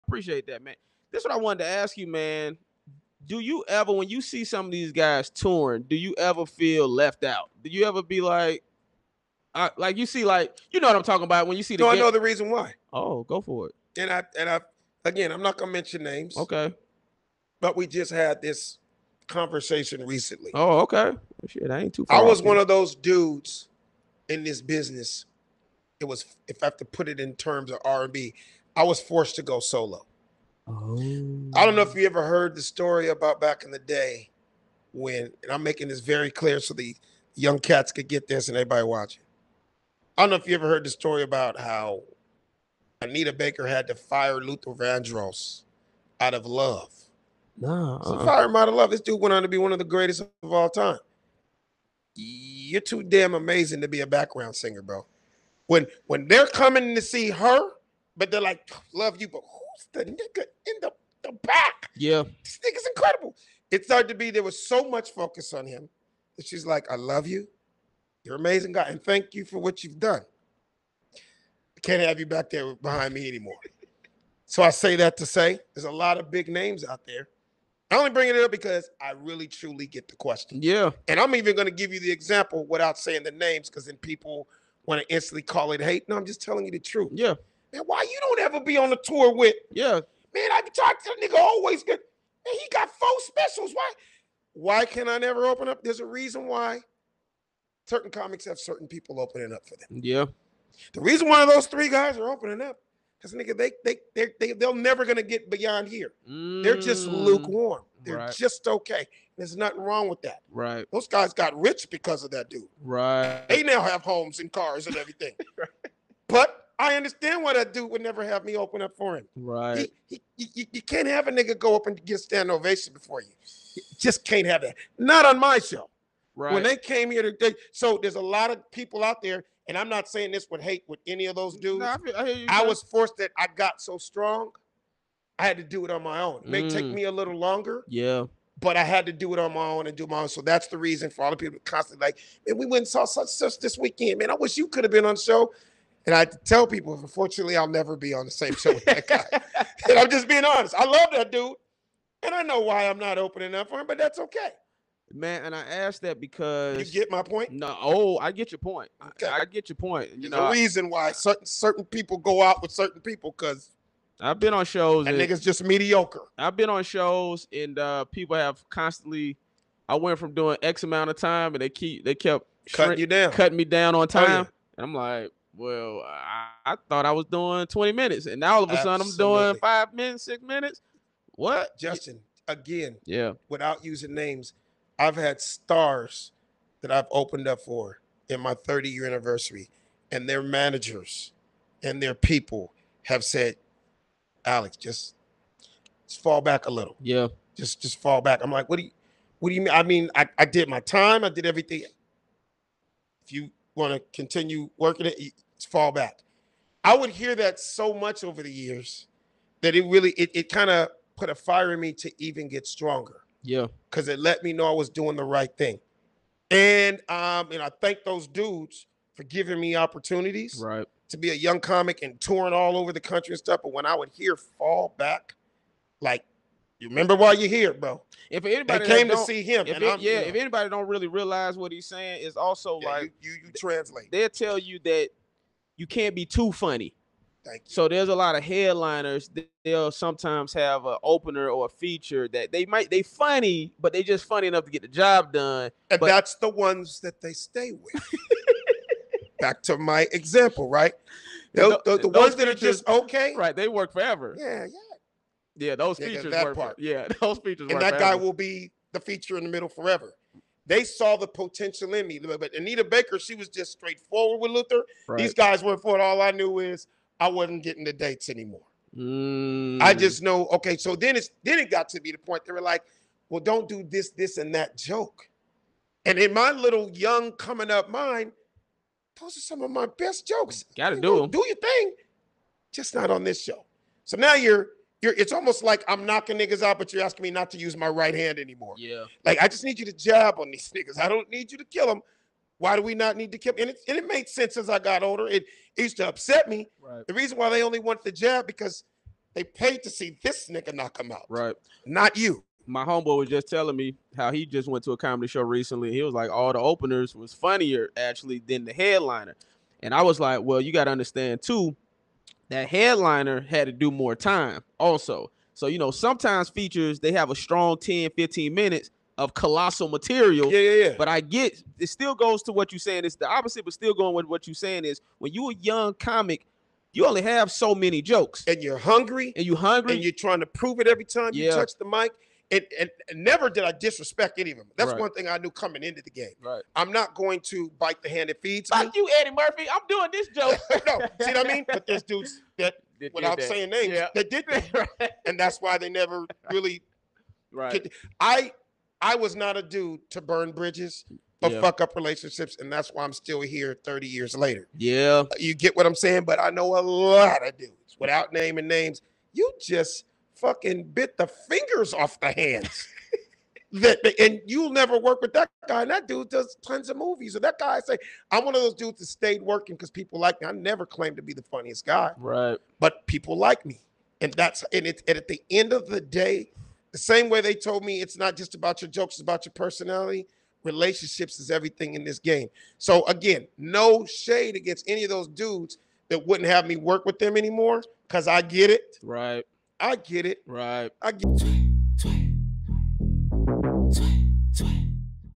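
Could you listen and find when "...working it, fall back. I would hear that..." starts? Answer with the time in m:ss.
3:24.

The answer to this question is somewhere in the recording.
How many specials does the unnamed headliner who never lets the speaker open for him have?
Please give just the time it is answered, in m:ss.
1:32.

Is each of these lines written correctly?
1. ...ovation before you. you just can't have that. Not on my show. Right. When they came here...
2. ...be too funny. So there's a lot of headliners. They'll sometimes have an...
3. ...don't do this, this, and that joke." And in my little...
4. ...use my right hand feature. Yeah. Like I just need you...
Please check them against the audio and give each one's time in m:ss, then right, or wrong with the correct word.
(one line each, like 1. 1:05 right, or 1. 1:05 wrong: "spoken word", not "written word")
1. 2:02 right
2. 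3:56 right
3. 4:33 right
4. 4:47 wrong: "anymore", not "feature".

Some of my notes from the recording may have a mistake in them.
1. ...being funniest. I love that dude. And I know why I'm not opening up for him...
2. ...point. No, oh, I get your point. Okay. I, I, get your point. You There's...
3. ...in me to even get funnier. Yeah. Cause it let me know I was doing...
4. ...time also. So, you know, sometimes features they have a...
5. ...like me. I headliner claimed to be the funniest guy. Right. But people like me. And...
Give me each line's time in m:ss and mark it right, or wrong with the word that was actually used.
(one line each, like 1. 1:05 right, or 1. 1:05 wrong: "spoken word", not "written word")
1. 2:30 wrong: "honest", not "funniest"
2. 2:37 right
3. 3:31 wrong: "stronger", not "funnier"
4. 5:14 right
5. 6:10 wrong: "never", not "headliner".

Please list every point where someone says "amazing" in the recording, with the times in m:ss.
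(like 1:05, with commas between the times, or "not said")
0:53, 1:08.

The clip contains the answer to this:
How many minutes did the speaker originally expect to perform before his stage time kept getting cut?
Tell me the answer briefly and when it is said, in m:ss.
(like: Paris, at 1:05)
20, at 2:57.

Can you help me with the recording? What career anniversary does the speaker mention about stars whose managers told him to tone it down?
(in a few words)
30 year.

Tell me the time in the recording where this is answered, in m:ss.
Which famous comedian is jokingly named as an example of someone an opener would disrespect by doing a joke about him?
5:39.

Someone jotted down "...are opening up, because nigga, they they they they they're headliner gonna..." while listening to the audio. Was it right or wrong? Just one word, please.
wrong.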